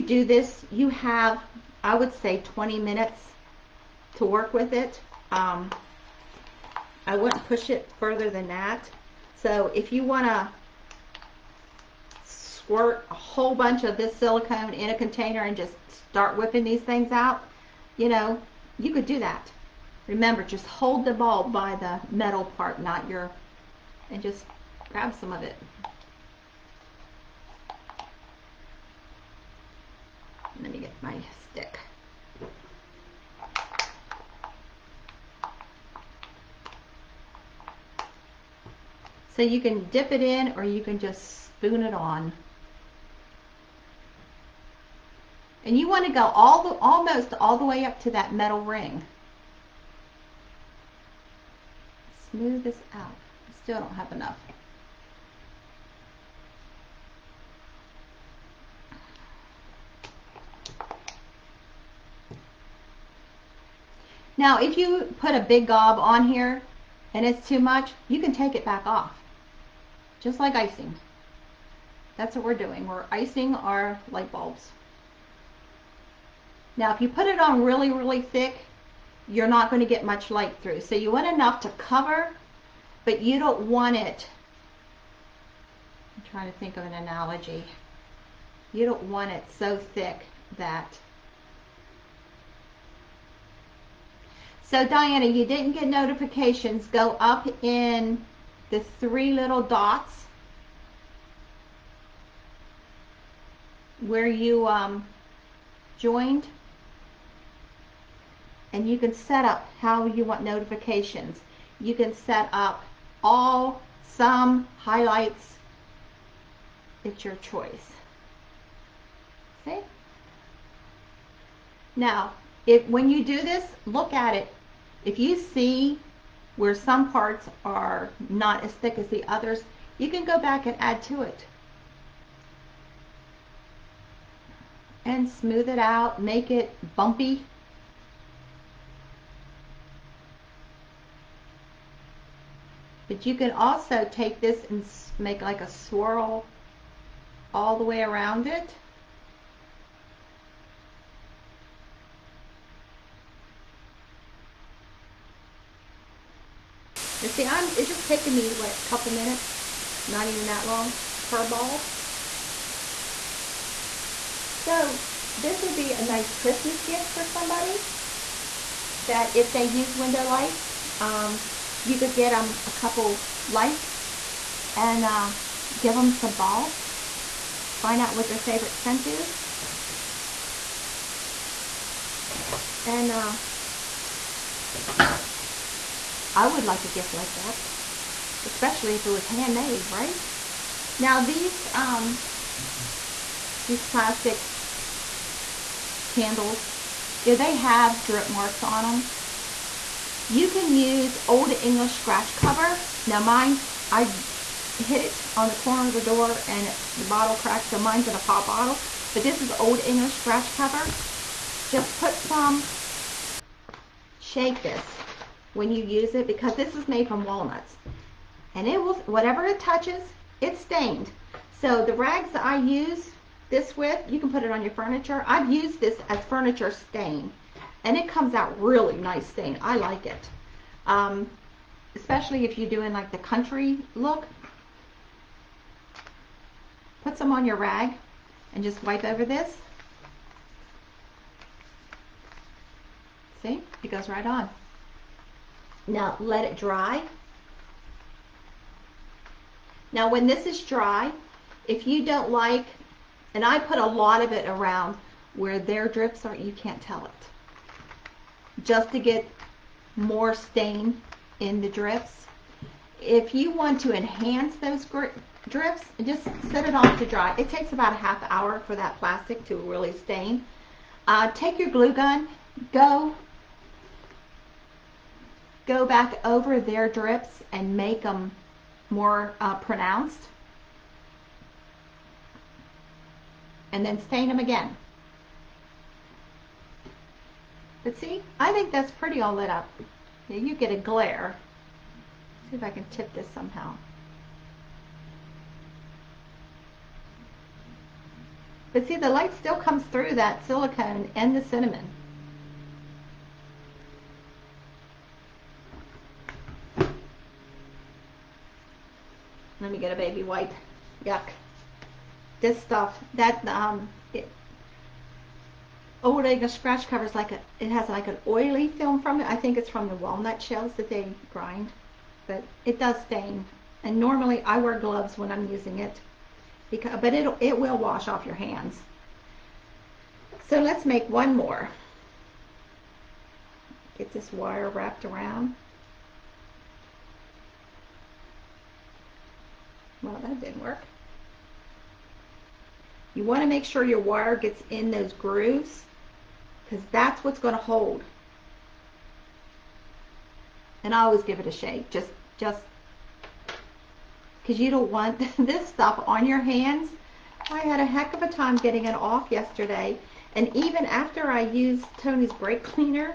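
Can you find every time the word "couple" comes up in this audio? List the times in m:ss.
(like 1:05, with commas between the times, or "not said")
2:38, 2:52.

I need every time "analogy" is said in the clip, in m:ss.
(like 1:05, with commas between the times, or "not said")
1:26.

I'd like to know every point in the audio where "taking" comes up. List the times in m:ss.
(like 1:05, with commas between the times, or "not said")
2:38.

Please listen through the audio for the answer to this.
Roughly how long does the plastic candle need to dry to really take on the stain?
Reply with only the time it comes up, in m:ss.
4:27.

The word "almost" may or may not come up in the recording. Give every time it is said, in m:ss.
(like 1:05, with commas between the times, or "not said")
0:46.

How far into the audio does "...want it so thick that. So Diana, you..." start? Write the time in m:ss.
1:29.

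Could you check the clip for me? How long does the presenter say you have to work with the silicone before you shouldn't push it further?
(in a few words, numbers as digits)
20 minutes.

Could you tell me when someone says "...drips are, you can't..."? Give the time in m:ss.
4:15.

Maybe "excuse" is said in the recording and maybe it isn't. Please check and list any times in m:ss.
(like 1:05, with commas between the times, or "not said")
not said.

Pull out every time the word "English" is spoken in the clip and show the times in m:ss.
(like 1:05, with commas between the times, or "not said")
3:21, 3:29.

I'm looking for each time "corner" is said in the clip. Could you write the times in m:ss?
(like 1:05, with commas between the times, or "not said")
3:25.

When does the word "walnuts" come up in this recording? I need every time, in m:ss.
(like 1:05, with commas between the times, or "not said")
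3:37, 5:19.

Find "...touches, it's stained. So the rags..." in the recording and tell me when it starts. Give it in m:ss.
3:39.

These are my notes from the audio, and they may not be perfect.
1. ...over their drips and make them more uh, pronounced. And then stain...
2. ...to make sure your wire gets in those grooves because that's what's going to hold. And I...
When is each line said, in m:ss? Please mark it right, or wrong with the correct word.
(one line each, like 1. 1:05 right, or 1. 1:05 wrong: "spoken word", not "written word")
1. 4:36 right
2. 5:43 right.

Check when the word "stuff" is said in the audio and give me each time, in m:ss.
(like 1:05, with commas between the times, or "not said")
5:12, 5:55.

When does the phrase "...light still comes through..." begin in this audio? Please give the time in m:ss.
4:59.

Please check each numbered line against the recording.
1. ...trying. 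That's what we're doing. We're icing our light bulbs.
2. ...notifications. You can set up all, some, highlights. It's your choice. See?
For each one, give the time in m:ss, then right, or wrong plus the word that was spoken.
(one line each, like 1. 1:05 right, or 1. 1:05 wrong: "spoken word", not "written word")
1. 1:10 wrong: "icing", not "trying"
2. 1:50 right.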